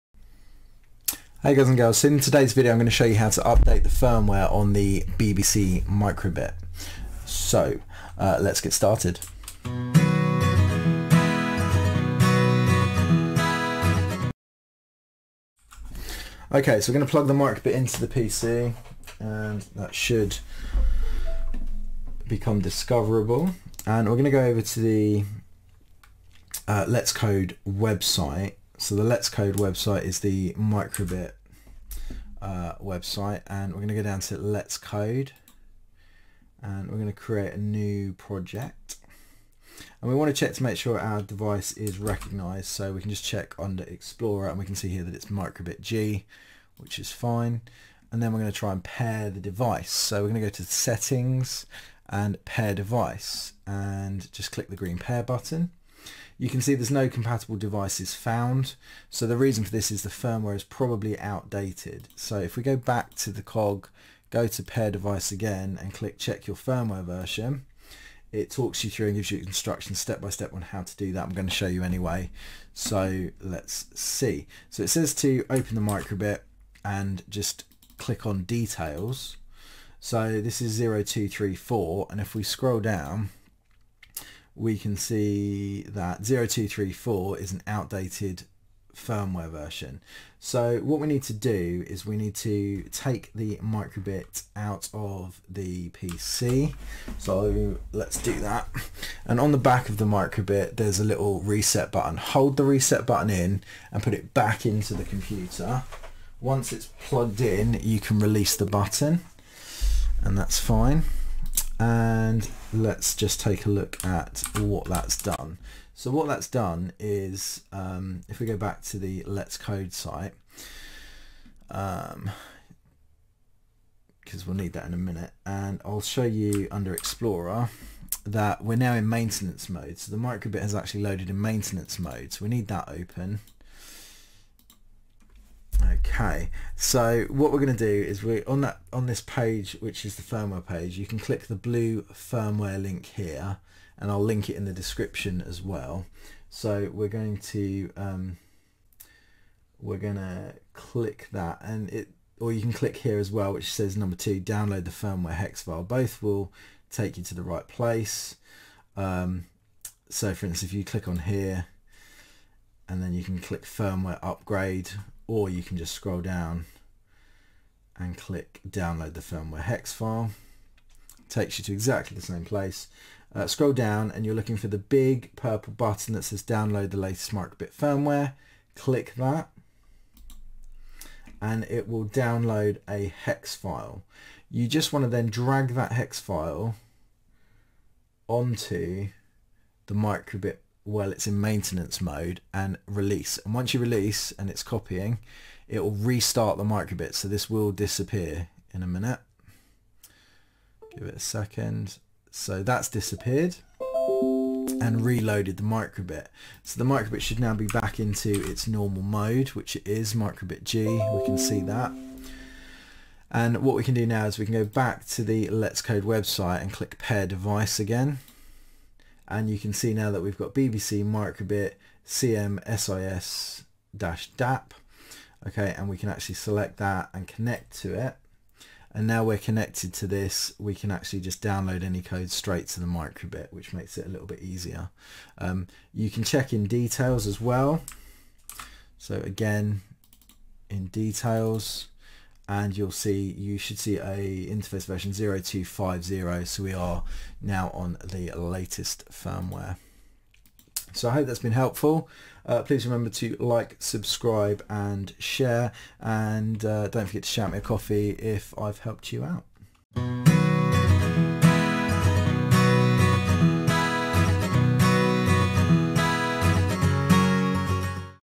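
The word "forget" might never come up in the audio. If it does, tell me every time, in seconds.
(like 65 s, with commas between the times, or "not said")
257 s.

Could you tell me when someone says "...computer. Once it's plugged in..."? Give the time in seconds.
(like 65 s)
105 s.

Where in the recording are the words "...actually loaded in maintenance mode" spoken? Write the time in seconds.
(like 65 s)
130 s.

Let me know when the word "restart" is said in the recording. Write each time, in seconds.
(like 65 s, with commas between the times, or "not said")
195 s.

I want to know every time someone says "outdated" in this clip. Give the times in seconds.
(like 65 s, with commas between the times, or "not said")
61 s, 87 s.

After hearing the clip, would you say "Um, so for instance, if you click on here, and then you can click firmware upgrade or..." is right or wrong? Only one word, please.
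right.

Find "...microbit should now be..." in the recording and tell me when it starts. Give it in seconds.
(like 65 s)
206 s.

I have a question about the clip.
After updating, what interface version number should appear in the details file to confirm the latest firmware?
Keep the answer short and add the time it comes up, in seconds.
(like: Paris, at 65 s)
0250, at 245 s.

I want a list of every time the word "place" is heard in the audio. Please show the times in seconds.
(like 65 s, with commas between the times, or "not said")
157 s, 172 s.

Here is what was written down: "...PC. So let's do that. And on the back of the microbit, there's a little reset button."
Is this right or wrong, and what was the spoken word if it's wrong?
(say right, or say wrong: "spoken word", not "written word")
right.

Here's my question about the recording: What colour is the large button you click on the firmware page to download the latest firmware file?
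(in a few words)
purple.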